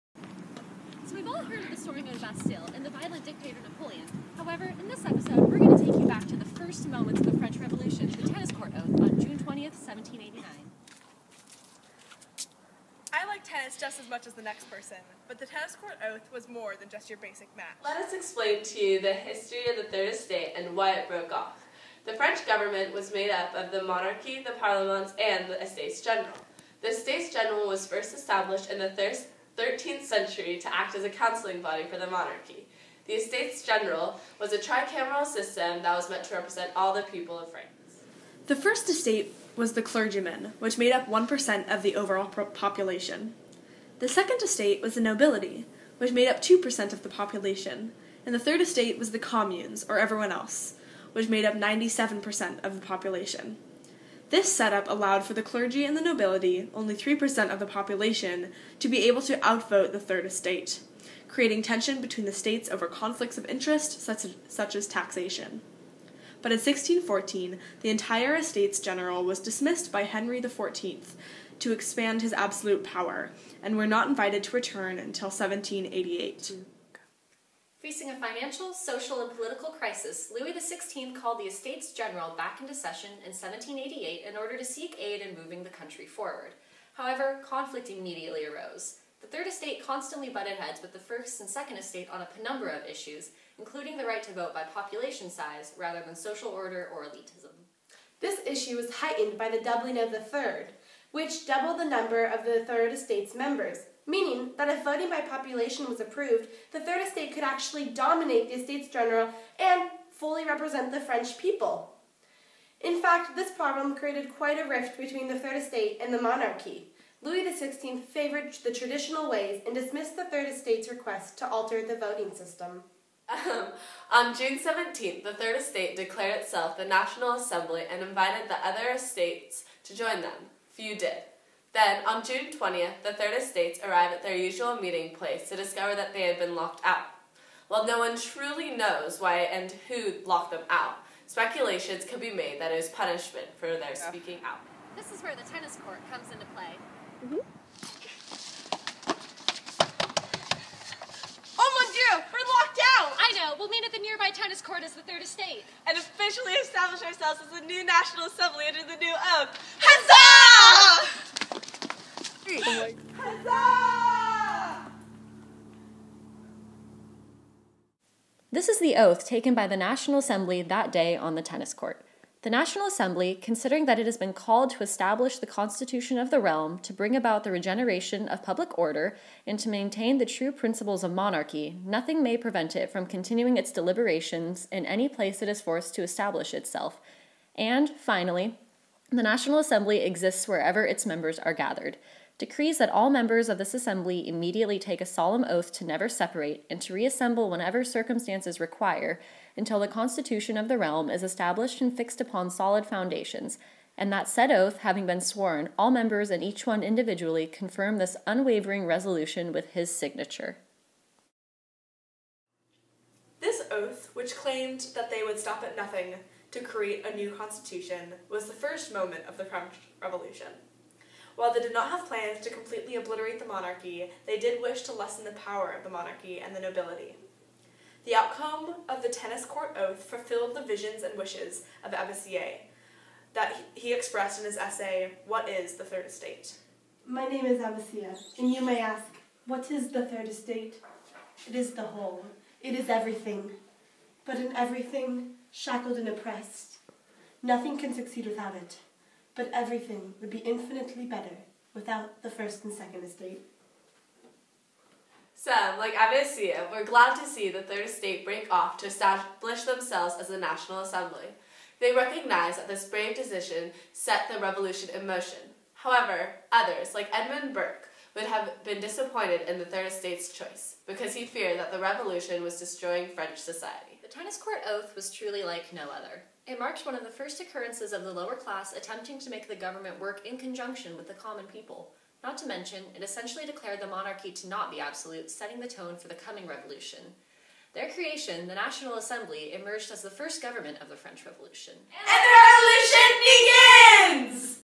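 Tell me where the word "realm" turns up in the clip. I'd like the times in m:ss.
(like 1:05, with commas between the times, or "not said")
2:56, 3:20.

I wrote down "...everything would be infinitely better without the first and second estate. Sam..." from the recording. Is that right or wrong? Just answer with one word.
right.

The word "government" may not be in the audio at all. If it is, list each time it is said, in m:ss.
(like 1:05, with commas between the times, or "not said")
0:22, 4:39, 4:50.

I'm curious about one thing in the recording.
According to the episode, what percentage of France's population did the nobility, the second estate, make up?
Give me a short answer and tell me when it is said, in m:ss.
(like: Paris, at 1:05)
2%, at 0:46.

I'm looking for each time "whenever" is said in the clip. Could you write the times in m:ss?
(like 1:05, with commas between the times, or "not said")
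3:17.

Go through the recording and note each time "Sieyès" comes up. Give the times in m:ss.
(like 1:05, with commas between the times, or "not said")
3:52, 3:57.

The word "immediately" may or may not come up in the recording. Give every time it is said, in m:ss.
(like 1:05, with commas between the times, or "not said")
1:27, 3:14.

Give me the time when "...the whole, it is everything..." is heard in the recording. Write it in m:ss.
4:01.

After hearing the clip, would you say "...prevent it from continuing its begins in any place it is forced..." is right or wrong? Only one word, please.
wrong.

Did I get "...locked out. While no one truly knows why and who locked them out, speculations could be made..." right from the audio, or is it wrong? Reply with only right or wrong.
right.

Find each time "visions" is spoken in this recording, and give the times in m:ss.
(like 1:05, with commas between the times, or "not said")
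3:50.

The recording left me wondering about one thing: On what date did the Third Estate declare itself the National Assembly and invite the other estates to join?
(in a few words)
June 17th.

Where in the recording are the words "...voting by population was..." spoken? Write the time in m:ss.
1:44.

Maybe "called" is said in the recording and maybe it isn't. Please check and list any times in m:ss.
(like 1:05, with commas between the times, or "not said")
1:21, 2:54.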